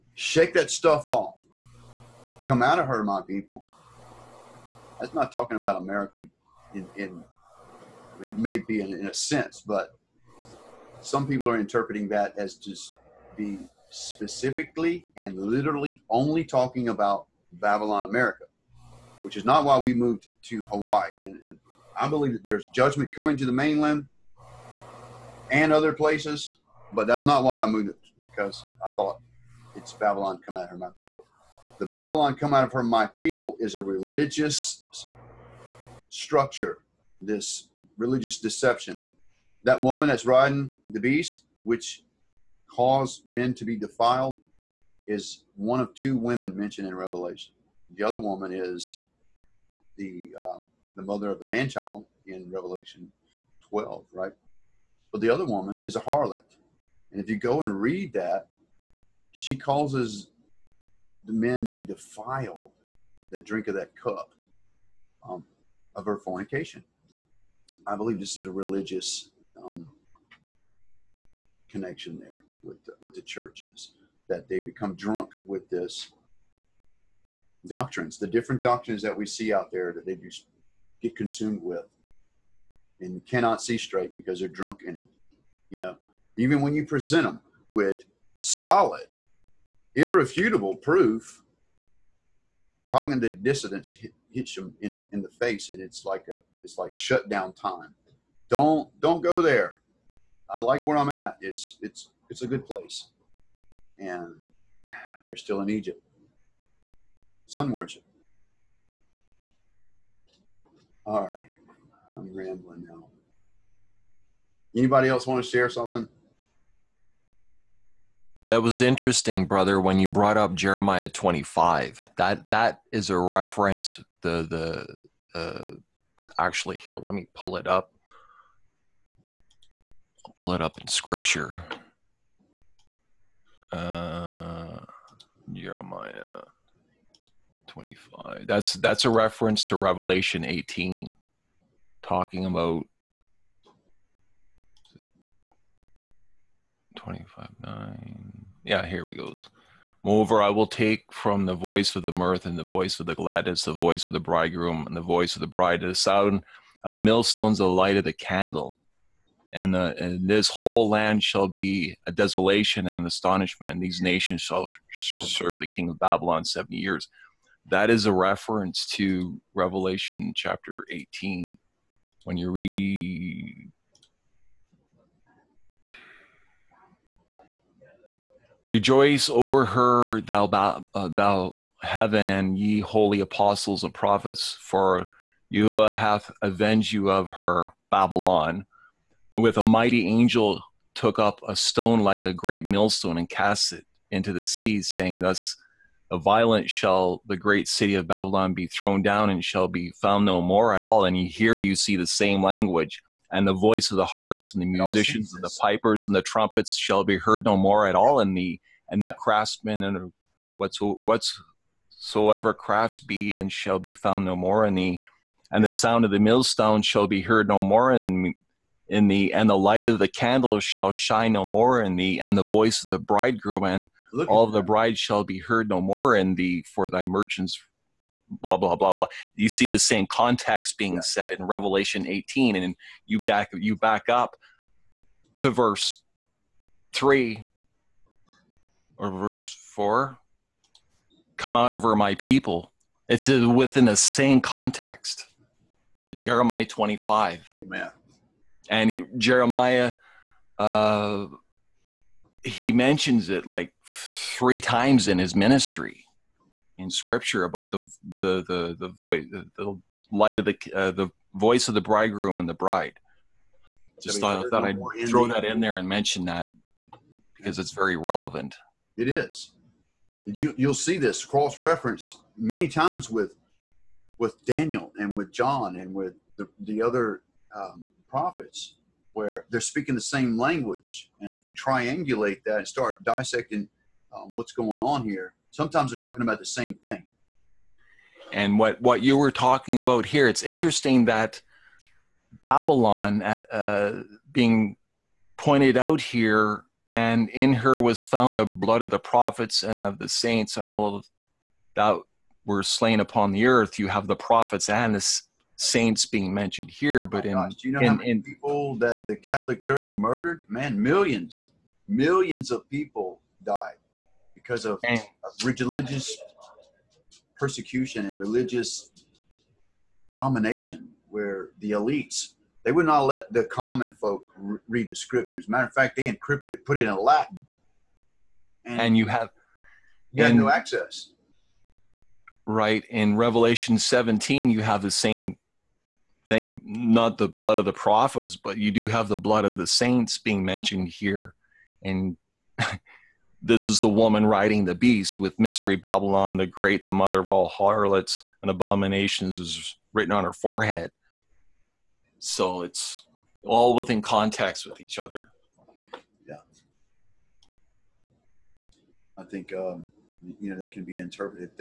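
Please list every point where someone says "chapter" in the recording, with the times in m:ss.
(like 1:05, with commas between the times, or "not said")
2:50.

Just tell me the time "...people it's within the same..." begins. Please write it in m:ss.
4:02.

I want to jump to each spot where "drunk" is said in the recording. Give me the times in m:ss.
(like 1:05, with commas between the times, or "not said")
1:14, 1:24.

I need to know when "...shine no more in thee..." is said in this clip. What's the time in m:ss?
3:40.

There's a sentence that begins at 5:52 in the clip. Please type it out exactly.
So it's all within context with each other.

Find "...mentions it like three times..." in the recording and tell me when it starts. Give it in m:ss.
4:12.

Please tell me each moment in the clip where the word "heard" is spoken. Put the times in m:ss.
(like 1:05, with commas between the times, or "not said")
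3:27, 3:37, 3:45.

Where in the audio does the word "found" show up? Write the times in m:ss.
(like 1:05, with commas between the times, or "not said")
3:20, 3:33, 4:58.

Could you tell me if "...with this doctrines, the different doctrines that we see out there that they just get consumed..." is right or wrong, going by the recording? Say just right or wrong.
right.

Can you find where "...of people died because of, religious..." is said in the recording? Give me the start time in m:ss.
5:12.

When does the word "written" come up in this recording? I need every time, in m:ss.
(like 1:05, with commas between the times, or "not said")
5:49.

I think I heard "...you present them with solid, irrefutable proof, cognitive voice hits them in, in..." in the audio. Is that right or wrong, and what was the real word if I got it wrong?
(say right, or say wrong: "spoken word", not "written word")
wrong: "dissonance", not "voice".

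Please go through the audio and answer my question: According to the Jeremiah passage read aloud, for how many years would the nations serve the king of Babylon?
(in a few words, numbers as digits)
70.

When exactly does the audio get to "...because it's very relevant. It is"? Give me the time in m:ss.
4:27.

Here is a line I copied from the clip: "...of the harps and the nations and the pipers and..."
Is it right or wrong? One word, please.
wrong.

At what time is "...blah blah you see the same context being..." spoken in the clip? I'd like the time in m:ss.
3:48.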